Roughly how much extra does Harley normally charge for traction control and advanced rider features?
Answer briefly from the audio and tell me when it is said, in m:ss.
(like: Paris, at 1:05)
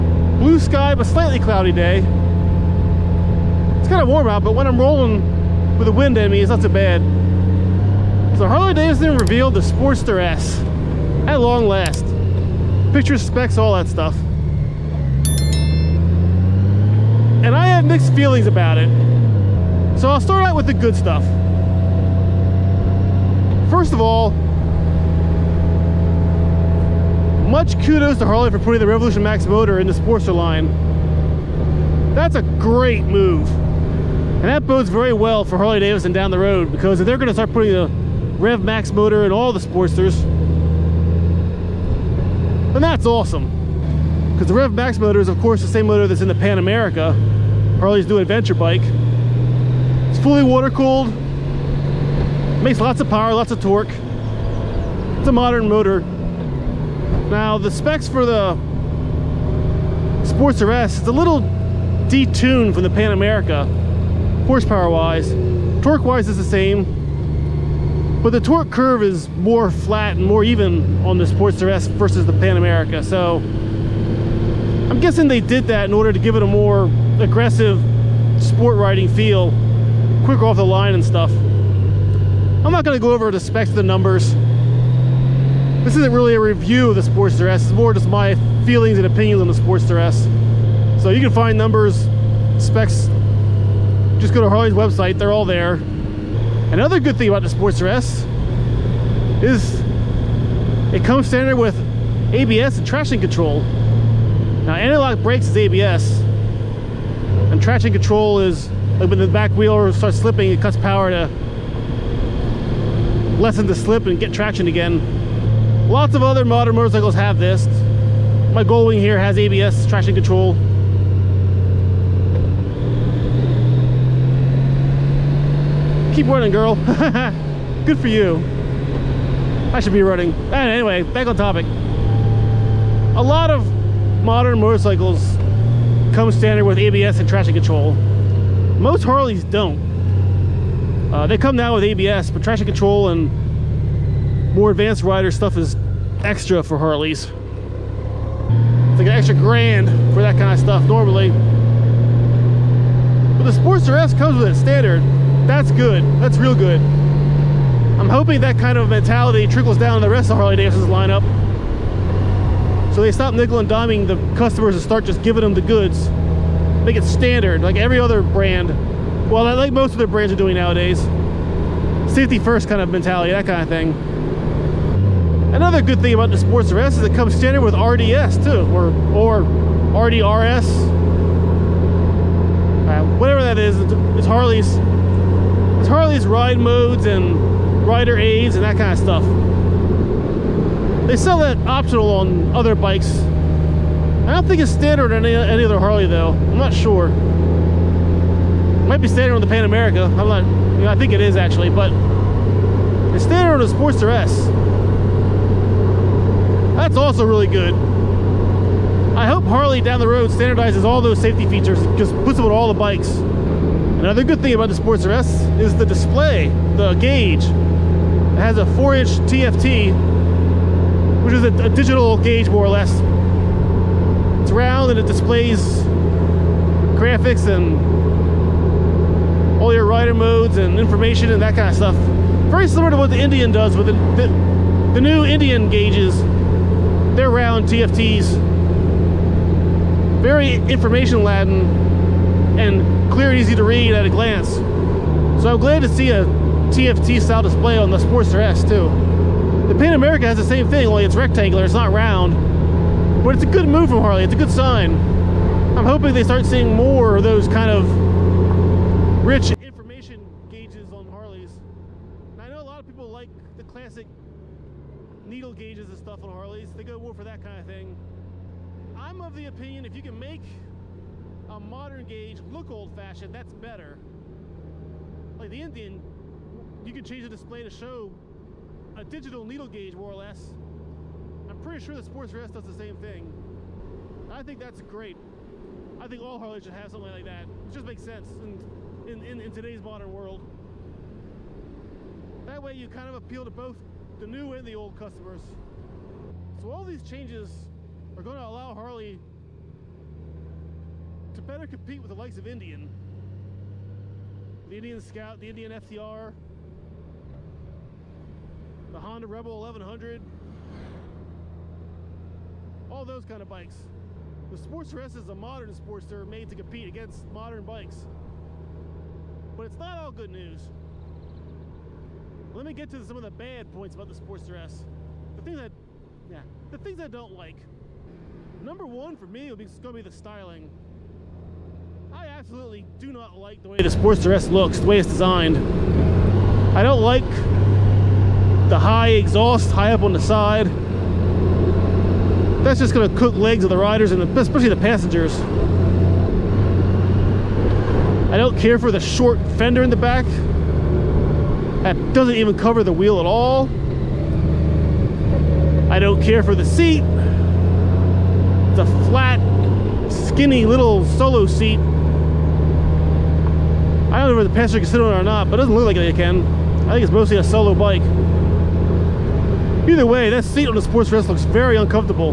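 an extra grand, at 2:29.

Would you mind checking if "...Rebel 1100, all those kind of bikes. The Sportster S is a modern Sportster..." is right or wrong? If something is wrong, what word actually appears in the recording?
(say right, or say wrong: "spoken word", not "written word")
right.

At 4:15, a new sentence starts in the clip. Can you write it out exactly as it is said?
I'm hoping they start seeing more of those kind of rich information gauges on Harleys.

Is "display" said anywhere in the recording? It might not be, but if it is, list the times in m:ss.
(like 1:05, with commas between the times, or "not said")
3:35, 3:45, 4:07, 4:37.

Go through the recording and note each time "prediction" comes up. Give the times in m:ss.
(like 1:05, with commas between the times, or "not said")
not said.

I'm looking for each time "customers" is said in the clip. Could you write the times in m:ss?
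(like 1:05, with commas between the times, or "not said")
2:44, 4:54.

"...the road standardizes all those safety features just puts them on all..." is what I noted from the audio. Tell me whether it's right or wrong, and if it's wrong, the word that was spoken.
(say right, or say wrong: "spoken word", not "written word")
right.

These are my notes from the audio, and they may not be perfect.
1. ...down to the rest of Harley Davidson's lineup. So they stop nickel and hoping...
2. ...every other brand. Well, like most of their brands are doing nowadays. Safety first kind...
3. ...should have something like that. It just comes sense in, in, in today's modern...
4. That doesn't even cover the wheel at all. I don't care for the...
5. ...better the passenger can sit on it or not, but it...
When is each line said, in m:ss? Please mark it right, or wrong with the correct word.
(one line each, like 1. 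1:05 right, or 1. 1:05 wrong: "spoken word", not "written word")
1. 2:39 wrong: "diming", not "hoping"
2. 2:47 right
3. 4:46 wrong: "makes", not "comes"
4. 5:51 right
5. 6:04 wrong: "whether", not "better".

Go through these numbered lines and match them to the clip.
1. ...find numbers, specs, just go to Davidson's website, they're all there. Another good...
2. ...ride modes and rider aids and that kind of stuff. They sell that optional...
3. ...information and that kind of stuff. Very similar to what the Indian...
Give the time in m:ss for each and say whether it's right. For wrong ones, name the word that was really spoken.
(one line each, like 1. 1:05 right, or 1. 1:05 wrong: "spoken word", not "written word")
1. 1:31 wrong: "Harley", not "Davidson"
2. 3:06 right
3. 3:50 right.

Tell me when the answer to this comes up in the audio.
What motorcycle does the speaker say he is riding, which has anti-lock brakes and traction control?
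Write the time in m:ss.
1:58.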